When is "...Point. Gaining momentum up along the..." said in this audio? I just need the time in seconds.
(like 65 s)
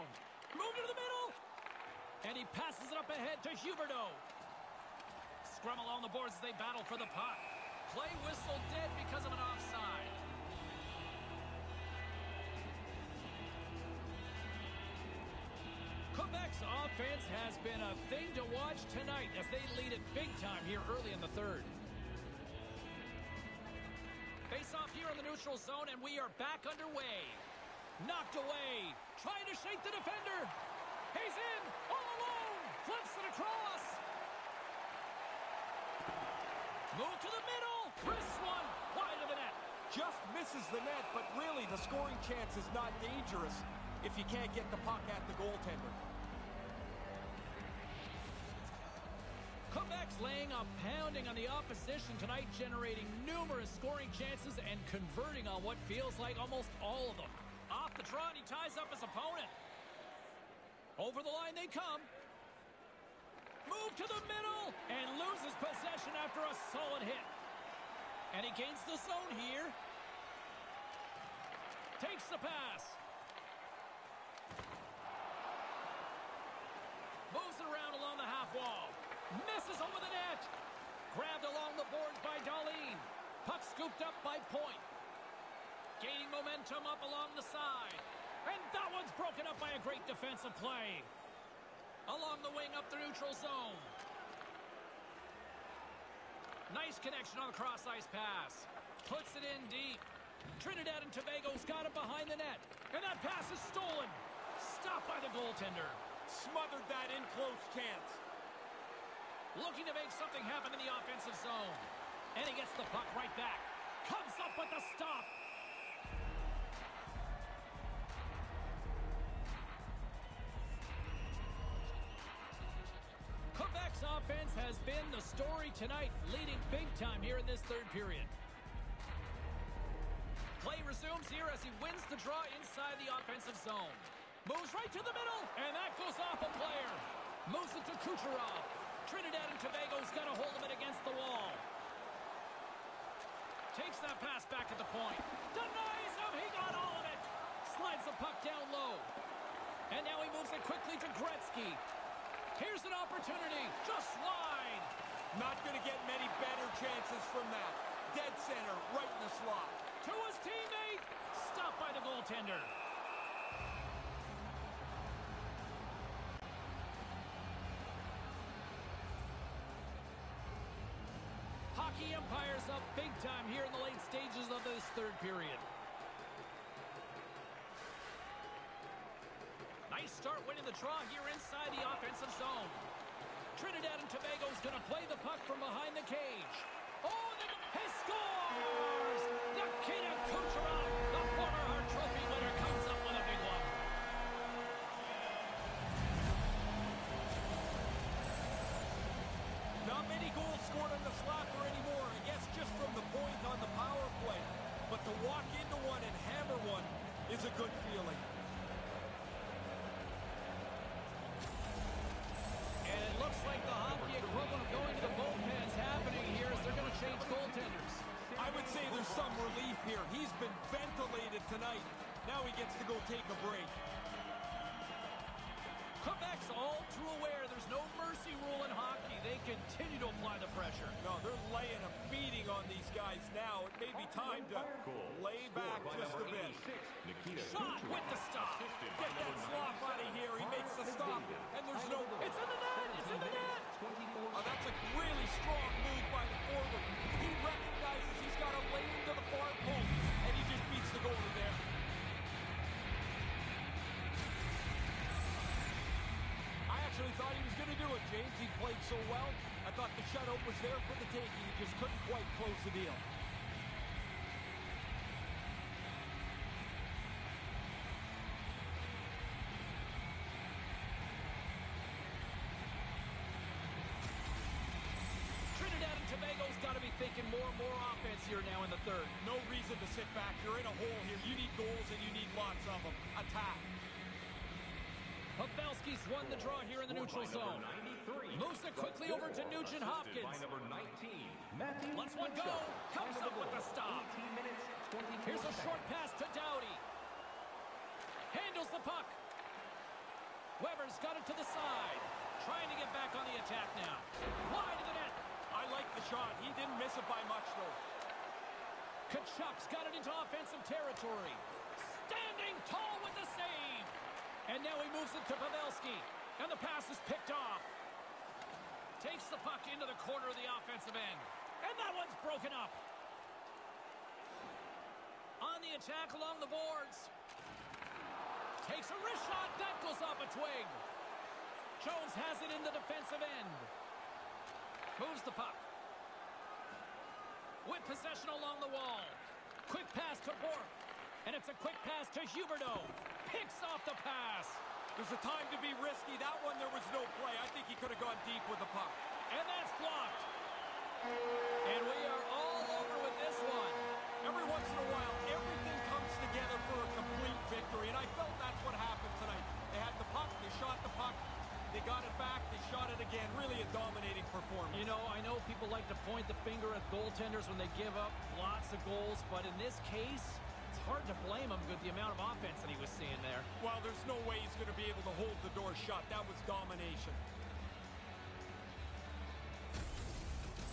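84 s.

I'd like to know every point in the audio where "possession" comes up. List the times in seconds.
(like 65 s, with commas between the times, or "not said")
65 s, 337 s.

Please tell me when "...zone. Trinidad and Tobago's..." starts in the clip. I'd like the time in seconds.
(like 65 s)
182 s.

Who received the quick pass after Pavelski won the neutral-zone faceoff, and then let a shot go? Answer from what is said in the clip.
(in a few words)
Nugent Hopkins.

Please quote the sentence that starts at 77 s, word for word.
Moves it around along the half wall.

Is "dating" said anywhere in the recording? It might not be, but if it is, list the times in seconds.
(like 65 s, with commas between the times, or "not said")
not said.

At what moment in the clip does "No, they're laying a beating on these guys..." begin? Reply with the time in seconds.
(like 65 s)
231 s.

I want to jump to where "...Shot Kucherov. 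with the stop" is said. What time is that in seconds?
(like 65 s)
237 s.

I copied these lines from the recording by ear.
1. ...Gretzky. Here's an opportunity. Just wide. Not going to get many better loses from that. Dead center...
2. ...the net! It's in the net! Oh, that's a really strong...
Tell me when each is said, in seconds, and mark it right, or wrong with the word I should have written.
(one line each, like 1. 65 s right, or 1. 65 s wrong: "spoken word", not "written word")
1. 151 s wrong: "chances", not "loses"
2. 242 s right.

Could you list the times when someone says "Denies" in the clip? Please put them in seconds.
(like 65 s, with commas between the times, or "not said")
145 s.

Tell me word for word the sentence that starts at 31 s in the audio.
He's in, all alone, flips it across.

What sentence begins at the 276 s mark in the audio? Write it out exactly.
Tobago's got to be thinking more and more offense here now in the third.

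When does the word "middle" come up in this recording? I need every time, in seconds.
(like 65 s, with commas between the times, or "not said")
1 s, 37 s, 64 s, 135 s.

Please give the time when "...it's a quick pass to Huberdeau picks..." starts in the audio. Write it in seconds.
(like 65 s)
341 s.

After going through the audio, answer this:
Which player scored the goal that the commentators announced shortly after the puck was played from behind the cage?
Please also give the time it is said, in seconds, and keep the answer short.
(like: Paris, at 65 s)
Nikita Kucherov, at 189 s.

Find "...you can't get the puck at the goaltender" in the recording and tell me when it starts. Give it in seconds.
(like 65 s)
44 s.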